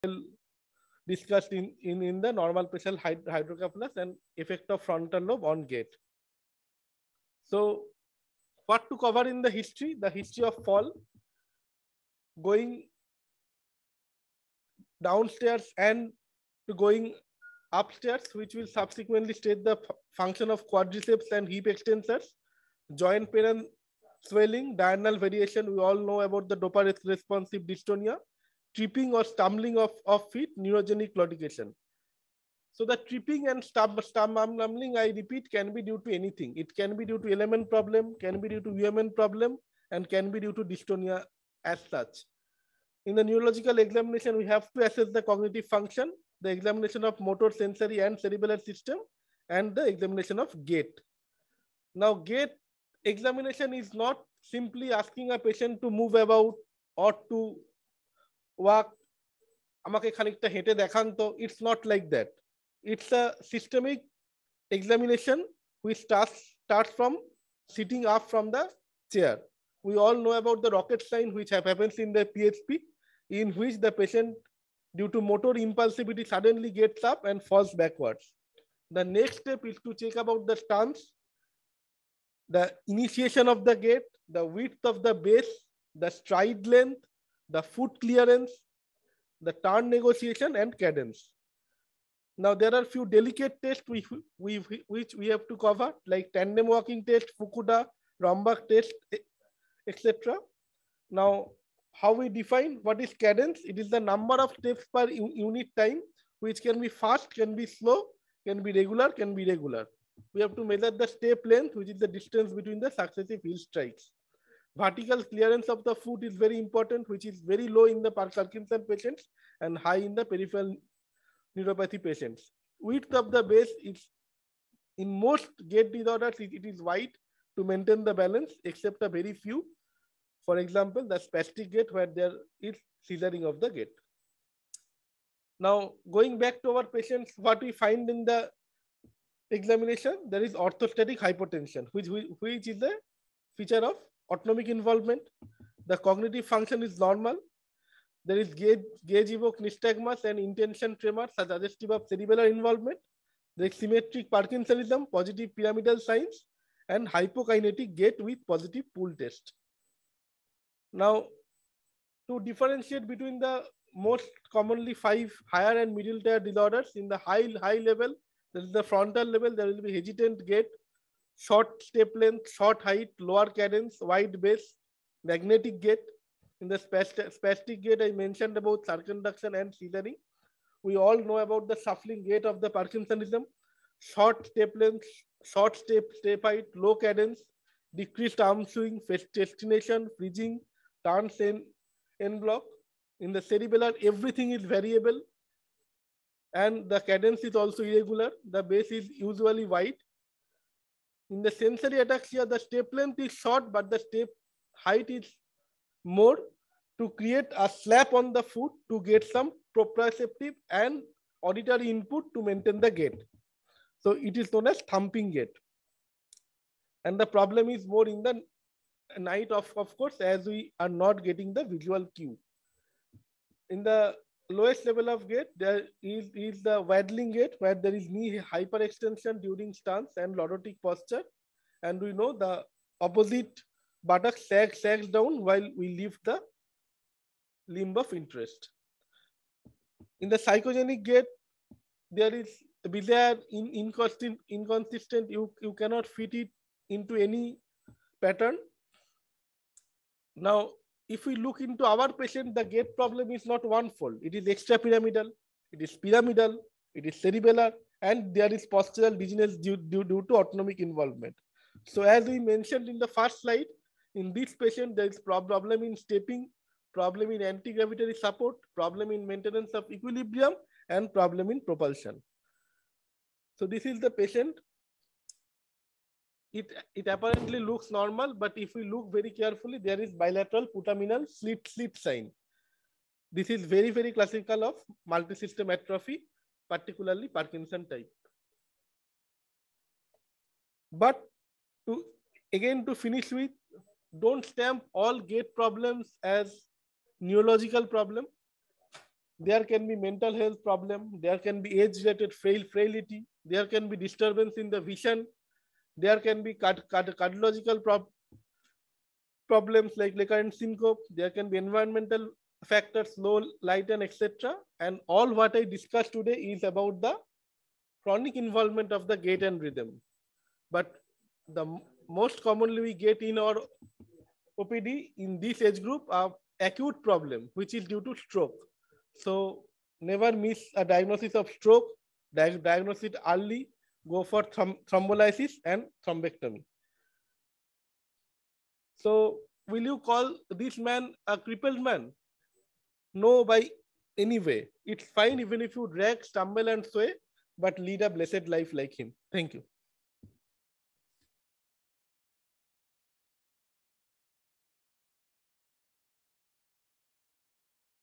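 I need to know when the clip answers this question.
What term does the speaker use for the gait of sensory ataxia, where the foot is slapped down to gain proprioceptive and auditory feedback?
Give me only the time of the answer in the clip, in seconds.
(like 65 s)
214 s.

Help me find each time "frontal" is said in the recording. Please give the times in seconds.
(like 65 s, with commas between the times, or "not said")
4 s, 168 s.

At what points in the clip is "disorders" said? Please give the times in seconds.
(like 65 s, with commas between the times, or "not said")
125 s, 166 s.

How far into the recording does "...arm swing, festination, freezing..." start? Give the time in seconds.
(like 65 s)
188 s.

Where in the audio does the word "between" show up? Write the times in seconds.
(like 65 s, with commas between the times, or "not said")
112 s, 163 s.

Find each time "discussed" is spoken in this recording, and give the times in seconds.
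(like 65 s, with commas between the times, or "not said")
1 s, 315 s.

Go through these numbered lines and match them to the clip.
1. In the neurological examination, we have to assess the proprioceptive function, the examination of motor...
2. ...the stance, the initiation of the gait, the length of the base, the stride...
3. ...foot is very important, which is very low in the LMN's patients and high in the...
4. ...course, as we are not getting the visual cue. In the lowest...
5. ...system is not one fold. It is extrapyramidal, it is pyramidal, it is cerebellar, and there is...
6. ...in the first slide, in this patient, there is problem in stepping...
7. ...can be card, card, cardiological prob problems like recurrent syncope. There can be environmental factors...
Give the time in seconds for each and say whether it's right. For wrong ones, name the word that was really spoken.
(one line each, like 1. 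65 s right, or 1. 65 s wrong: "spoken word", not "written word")
1. 43 s wrong: "cognitive", not "proprioceptive"
2. 80 s wrong: "width", not "length"
3. 115 s wrong: "Parkinson", not "LMN"
4. 219 s right
5. 252 s wrong: "problem", not "system"
6. 262 s right
7. 306 s right.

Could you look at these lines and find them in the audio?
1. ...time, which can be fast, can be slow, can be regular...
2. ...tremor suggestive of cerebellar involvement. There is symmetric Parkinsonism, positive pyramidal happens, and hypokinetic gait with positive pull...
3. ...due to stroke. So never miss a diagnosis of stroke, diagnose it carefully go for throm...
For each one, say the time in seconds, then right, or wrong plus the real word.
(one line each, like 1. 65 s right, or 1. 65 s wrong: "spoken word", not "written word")
1. 105 s right
2. 150 s wrong: "signs", not "happens"
3. 327 s wrong: "early", not "carefully".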